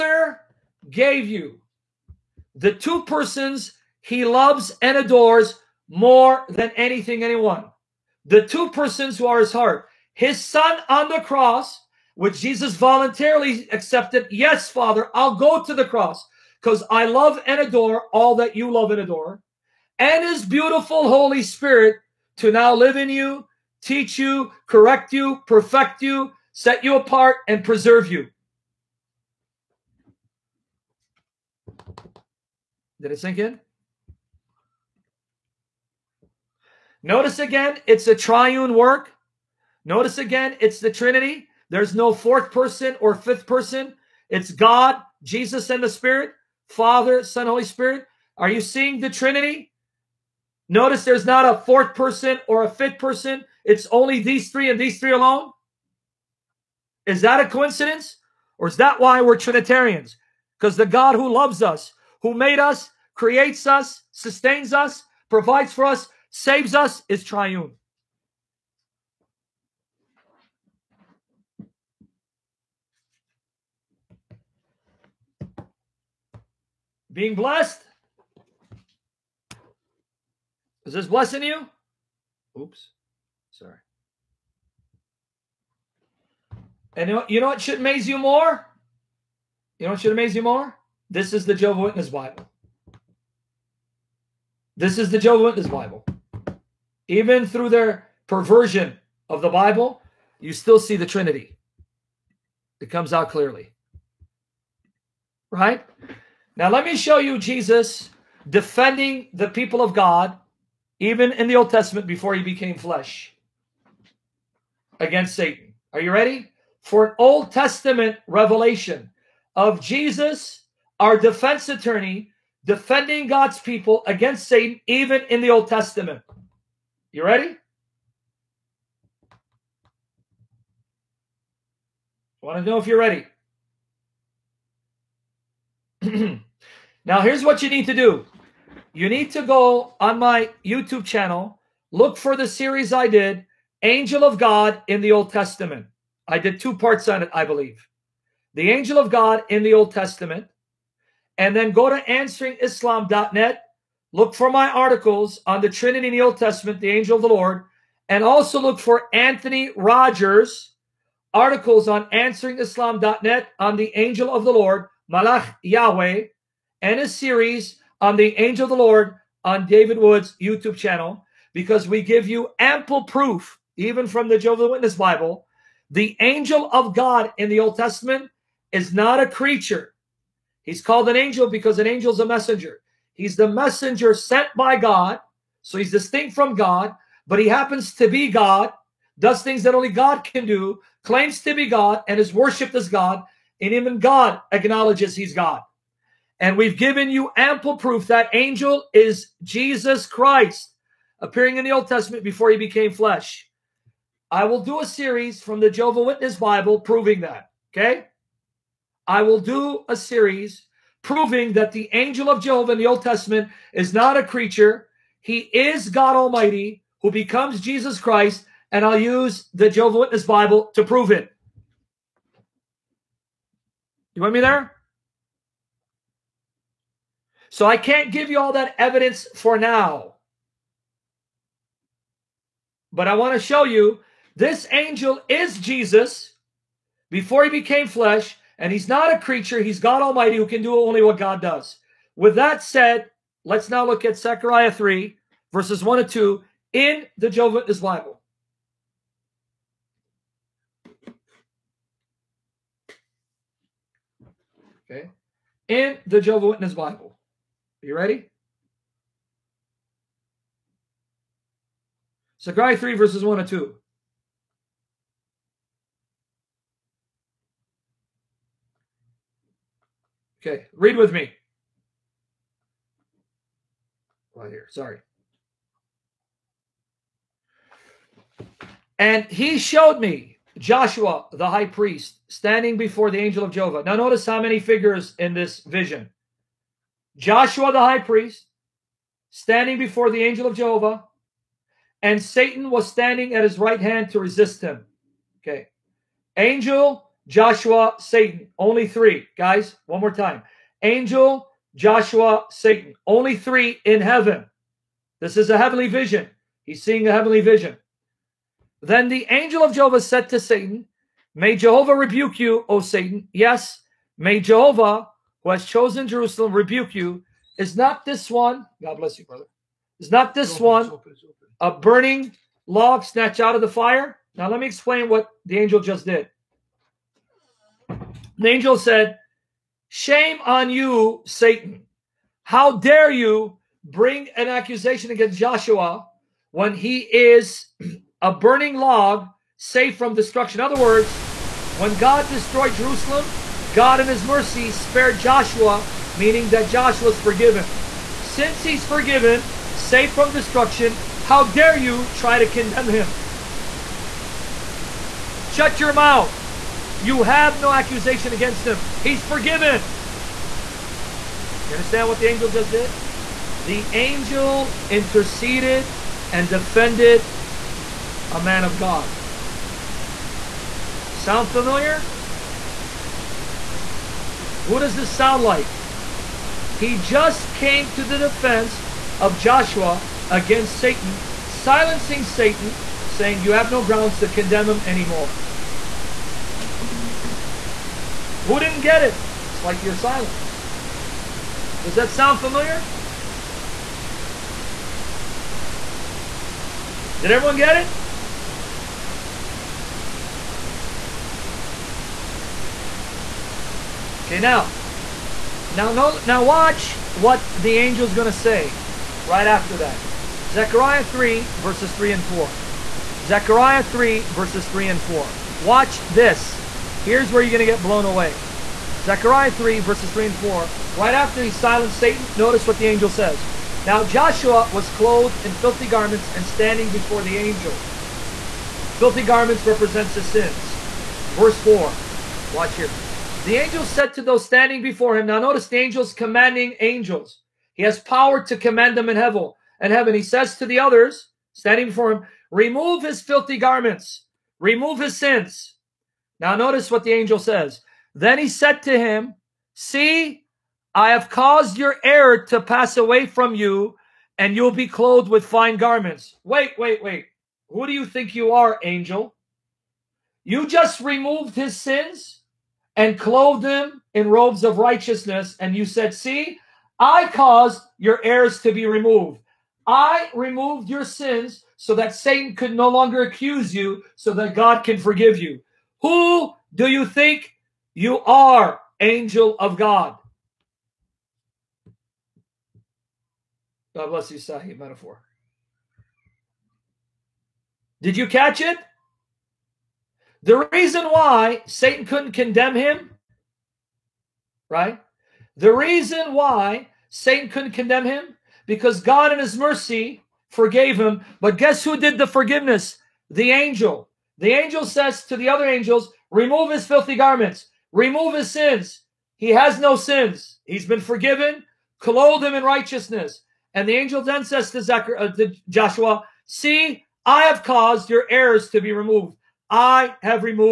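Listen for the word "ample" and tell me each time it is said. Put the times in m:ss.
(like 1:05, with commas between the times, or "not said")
2:52, 3:17.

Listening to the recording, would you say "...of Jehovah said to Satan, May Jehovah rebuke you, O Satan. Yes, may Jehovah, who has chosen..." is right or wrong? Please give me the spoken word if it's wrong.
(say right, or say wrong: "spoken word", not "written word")
right.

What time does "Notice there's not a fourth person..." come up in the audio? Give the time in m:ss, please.
0:50.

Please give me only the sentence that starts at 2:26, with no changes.
I did two parts on it, I believe.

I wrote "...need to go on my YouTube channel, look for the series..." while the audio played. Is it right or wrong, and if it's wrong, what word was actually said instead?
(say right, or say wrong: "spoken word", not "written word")
right.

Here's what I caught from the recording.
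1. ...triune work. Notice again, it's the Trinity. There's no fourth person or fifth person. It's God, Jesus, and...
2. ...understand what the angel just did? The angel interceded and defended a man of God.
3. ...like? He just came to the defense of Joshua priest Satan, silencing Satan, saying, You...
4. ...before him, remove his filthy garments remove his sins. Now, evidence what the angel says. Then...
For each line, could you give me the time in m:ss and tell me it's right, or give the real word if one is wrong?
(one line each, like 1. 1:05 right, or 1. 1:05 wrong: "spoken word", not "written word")
1. 0:38 right
2. 6:01 right
3. 6:15 wrong: "against", not "priest"
4. 7:21 wrong: "notice", not "evidence".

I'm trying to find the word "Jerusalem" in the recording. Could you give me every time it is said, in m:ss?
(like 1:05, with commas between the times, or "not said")
5:16, 5:42.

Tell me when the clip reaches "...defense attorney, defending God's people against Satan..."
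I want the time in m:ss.
2:01.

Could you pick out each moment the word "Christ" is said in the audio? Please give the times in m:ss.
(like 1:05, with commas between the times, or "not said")
3:20, 3:37.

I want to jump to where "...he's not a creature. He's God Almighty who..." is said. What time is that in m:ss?
3:58.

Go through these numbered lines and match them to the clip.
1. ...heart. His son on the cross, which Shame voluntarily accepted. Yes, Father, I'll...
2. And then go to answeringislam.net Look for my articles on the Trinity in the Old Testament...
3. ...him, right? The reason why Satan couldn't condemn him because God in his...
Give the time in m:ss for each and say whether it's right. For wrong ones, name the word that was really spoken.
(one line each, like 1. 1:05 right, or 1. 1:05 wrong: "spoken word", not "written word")
1. 0:09 wrong: "Jesus", not "Shame"
2. 2:31 right
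3. 8:12 right.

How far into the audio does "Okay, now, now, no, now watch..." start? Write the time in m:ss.
6:44.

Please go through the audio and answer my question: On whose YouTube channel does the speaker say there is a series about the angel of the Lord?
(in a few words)
David Wood.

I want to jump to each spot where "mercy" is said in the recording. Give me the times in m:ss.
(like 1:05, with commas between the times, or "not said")
5:44, 8:19.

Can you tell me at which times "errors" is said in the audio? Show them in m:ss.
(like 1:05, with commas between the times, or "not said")
7:32, 7:48, 8:38.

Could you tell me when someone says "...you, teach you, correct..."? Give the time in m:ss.
0:23.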